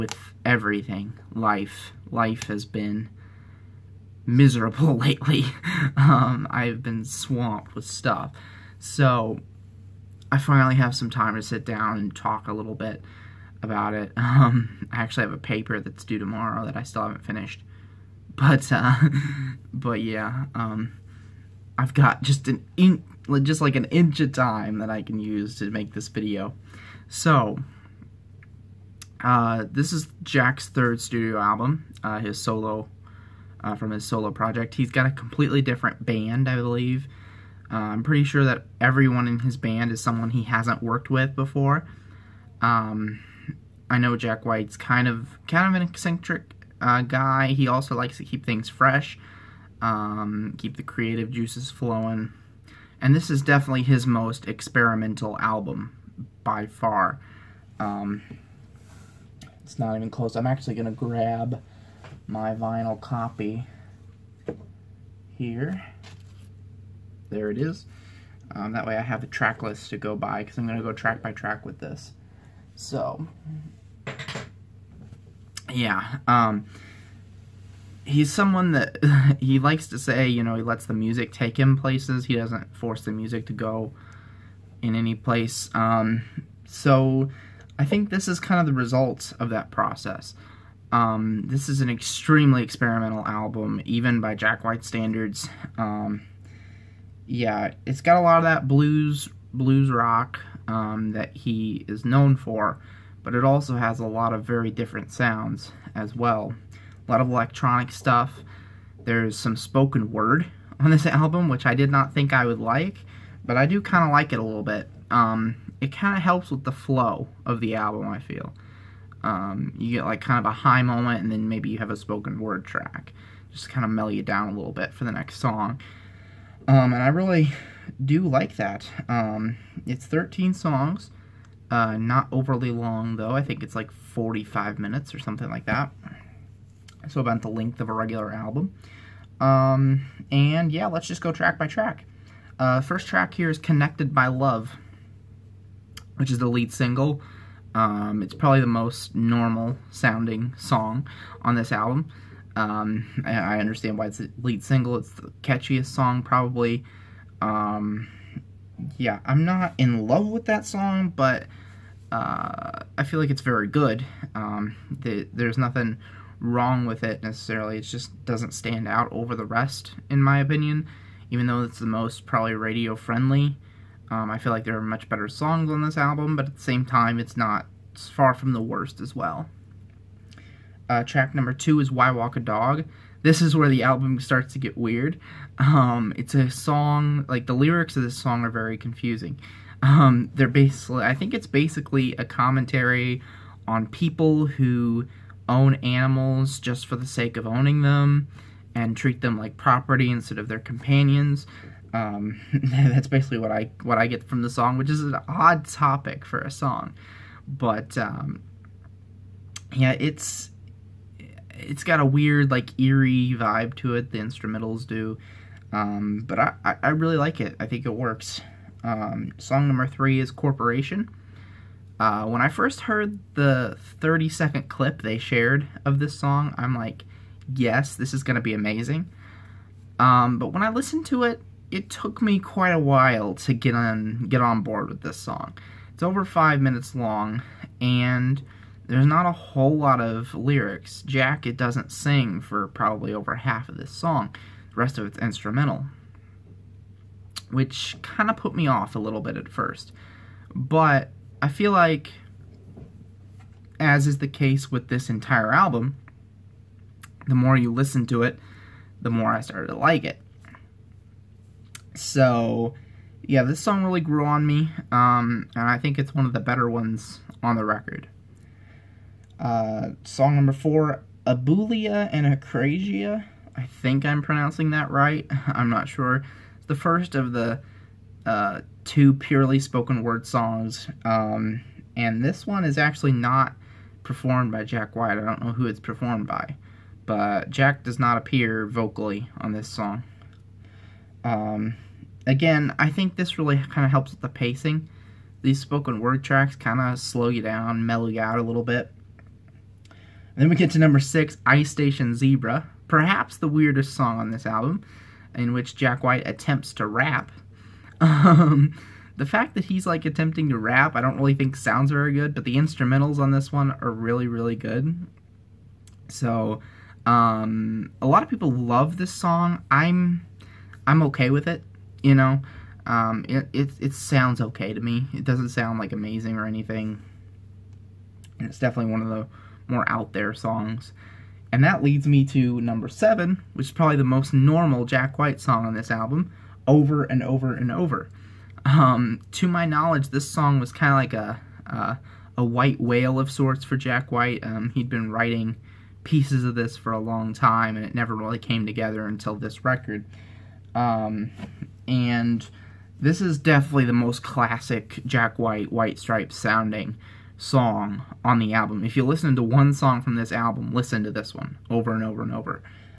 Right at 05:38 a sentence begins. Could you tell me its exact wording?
Um, to my knowledge, this song was kind of like a, a white whale of sorts for Jack White.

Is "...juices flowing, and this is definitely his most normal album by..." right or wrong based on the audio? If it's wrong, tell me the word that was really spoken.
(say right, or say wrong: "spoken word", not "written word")
wrong: "experimental", not "normal".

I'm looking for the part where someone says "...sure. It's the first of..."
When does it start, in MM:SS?
04:35.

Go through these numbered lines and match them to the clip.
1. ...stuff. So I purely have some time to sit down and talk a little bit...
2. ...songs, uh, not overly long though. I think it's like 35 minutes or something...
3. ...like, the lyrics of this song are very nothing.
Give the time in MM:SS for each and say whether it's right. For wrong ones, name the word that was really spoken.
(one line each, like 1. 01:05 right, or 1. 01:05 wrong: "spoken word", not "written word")
1. 00:07 wrong: "finally", not "purely"
2. 02:10 wrong: "45", not "35"
3. 03:07 wrong: "confusing", not "nothing".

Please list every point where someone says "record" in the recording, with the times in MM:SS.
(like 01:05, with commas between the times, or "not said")
04:27, 05:49.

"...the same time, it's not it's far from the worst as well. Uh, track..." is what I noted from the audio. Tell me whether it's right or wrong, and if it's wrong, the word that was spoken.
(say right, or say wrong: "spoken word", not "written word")
right.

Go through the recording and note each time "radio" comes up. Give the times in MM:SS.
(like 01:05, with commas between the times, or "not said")
02:52.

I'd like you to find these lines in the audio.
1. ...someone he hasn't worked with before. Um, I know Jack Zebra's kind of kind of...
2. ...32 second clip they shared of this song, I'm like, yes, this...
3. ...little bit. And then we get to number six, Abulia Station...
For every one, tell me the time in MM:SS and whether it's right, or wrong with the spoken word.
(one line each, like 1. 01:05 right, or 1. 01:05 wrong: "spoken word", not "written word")
1. 00:40 wrong: "White", not "Zebra"
2. 03:44 wrong: "30", not "32"
3. 04:58 wrong: "Ice", not "Abulia".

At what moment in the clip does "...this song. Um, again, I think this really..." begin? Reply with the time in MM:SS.
04:49.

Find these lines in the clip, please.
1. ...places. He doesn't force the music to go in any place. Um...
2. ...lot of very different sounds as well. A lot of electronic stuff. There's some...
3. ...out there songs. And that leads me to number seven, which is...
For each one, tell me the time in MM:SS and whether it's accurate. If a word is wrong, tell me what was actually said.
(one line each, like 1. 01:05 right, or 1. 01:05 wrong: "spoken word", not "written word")
1. 01:21 right
2. 01:44 right
3. 05:29 right.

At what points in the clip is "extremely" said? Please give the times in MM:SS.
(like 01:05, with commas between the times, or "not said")
01:31.